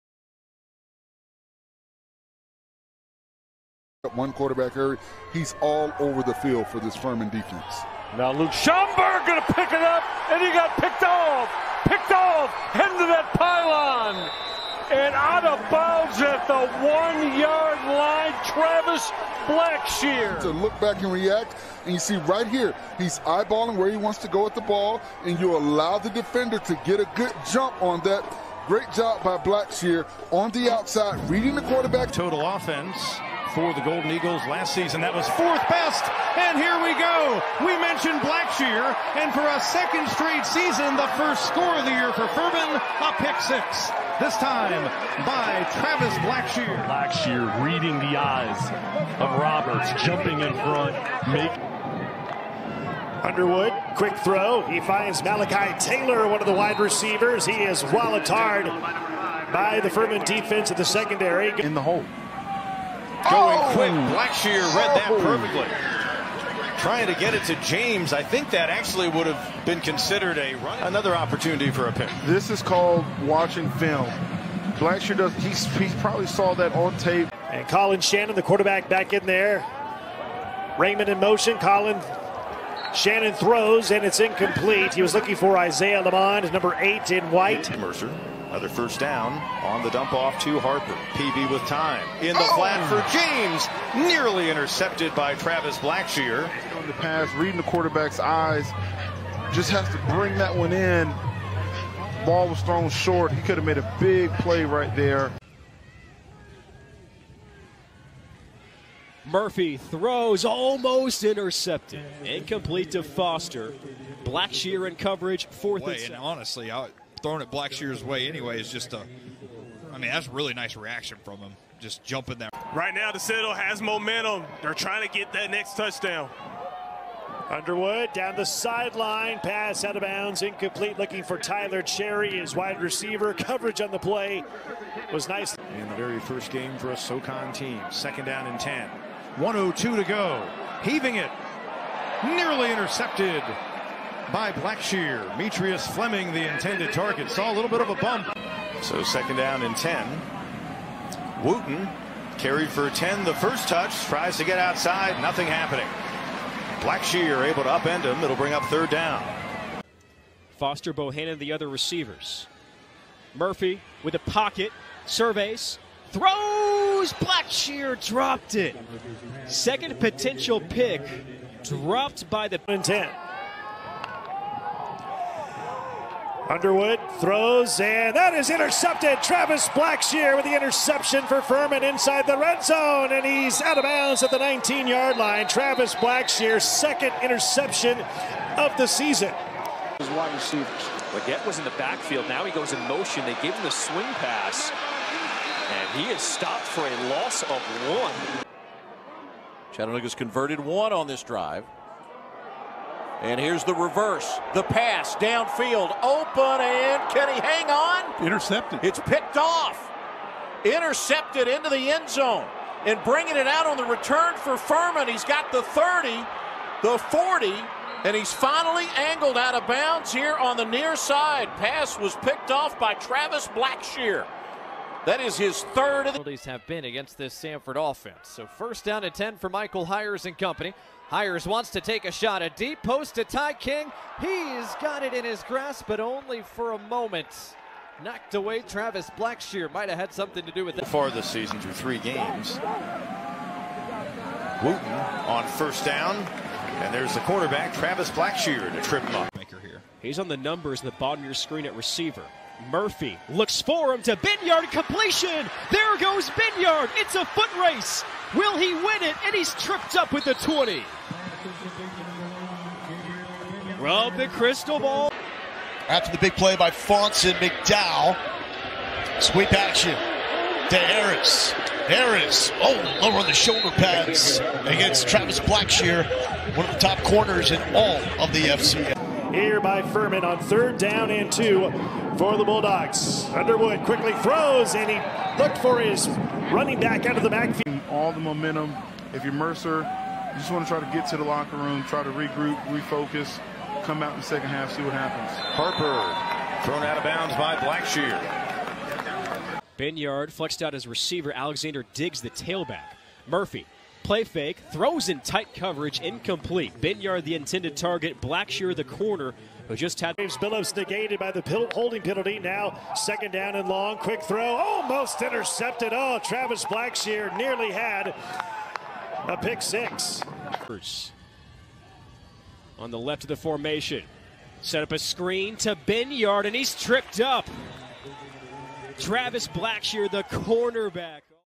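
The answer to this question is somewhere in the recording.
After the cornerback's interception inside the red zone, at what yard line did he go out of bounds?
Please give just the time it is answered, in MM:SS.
03:04.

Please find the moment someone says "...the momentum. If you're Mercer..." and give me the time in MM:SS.
04:48.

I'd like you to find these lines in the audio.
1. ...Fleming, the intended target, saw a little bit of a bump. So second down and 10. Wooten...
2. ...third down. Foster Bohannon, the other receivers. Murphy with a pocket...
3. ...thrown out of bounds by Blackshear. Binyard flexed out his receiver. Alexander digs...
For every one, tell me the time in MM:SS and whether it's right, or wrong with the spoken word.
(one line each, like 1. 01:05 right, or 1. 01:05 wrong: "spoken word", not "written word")
1. 02:25 right
2. 02:38 right
3. 04:56 right.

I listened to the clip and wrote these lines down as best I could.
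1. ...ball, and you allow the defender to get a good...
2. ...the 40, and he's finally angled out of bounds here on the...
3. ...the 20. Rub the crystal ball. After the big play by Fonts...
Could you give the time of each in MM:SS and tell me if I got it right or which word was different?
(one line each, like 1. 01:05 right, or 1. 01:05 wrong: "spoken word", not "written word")
1. 00:24 right
2. 03:36 right
3. 04:20 right.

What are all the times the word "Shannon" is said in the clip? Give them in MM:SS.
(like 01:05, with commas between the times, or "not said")
01:18, 01:22.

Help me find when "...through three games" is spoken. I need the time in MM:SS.
04:01.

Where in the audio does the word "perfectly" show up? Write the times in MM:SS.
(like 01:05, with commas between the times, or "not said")
01:05.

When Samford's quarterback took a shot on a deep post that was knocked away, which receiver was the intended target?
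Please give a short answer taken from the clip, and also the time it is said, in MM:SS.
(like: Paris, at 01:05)
Ty King, at 03:53.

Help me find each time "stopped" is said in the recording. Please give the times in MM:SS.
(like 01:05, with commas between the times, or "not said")
03:16.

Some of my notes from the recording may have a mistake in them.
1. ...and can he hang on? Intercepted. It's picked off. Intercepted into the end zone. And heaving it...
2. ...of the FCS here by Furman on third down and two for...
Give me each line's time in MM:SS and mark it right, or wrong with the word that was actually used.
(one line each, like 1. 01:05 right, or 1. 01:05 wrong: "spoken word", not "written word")
1. 03:26 wrong: "bringing", not "heaving"
2. 04:38 right.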